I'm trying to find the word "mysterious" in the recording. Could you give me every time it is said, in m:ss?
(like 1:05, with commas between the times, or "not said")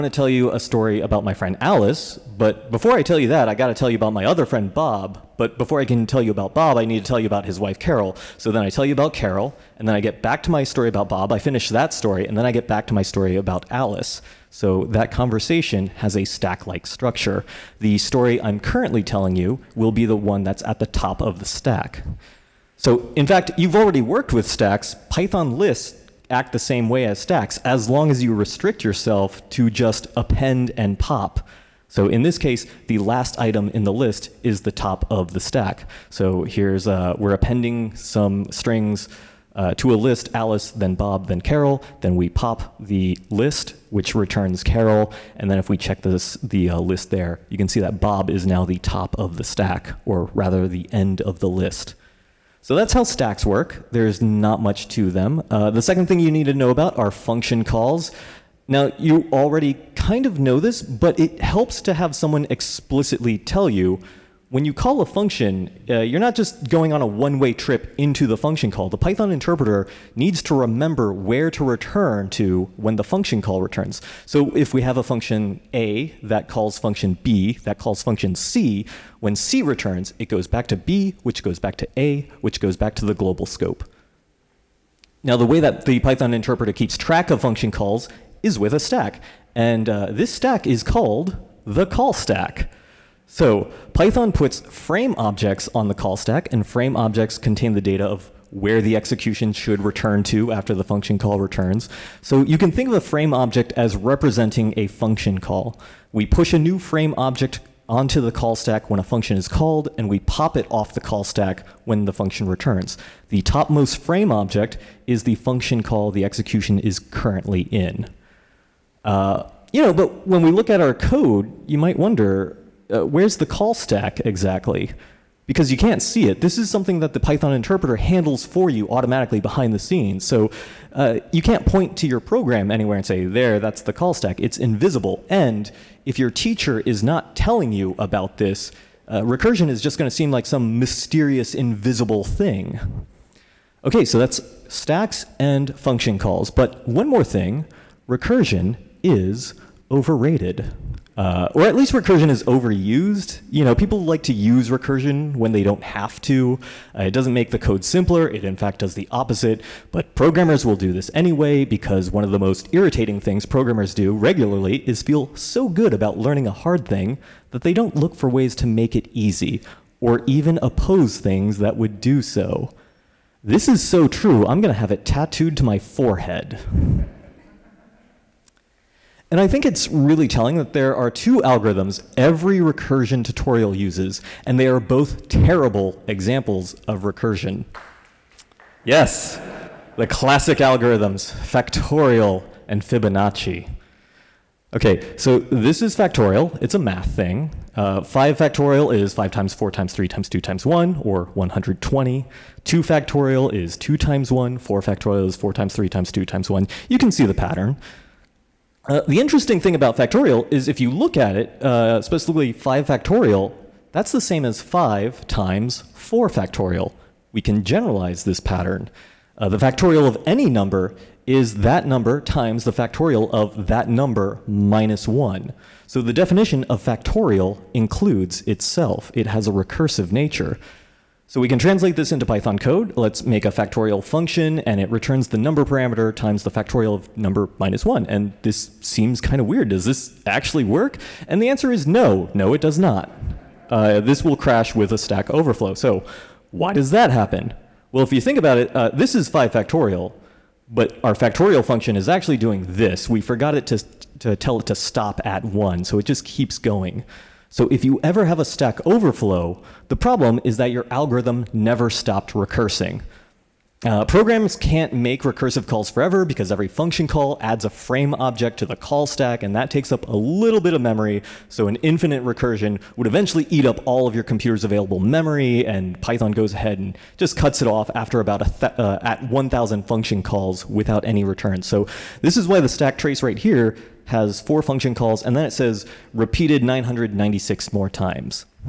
2:20.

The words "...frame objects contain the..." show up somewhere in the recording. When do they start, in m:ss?
1:36.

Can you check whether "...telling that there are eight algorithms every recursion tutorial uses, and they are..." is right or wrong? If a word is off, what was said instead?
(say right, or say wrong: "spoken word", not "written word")
wrong: "two", not "eight".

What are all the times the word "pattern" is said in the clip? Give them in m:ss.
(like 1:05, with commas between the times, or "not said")
3:27, 3:38.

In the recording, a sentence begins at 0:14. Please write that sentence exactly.
So that conversation has a stack like structure.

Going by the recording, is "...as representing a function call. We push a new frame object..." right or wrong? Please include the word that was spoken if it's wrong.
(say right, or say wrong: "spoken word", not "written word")
right.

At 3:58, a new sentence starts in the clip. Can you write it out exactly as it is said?
And this seems kind of weird.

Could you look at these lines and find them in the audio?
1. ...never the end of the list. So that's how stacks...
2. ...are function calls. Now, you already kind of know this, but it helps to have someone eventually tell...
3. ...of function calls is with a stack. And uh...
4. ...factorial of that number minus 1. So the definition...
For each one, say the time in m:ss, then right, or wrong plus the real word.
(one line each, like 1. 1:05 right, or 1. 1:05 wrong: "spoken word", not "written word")
1. 0:50 wrong: "rather", not "never"
2. 0:56 wrong: "explicitly", not "eventually"
3. 1:27 right
4. 3:42 right.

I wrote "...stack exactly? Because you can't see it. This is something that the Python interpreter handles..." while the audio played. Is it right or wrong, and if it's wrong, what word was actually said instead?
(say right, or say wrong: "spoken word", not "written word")
right.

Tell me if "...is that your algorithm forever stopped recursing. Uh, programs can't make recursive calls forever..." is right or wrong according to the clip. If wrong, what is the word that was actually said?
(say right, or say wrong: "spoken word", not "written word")
wrong: "never", not "forever".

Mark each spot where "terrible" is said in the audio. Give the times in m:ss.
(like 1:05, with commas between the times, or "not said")
3:05.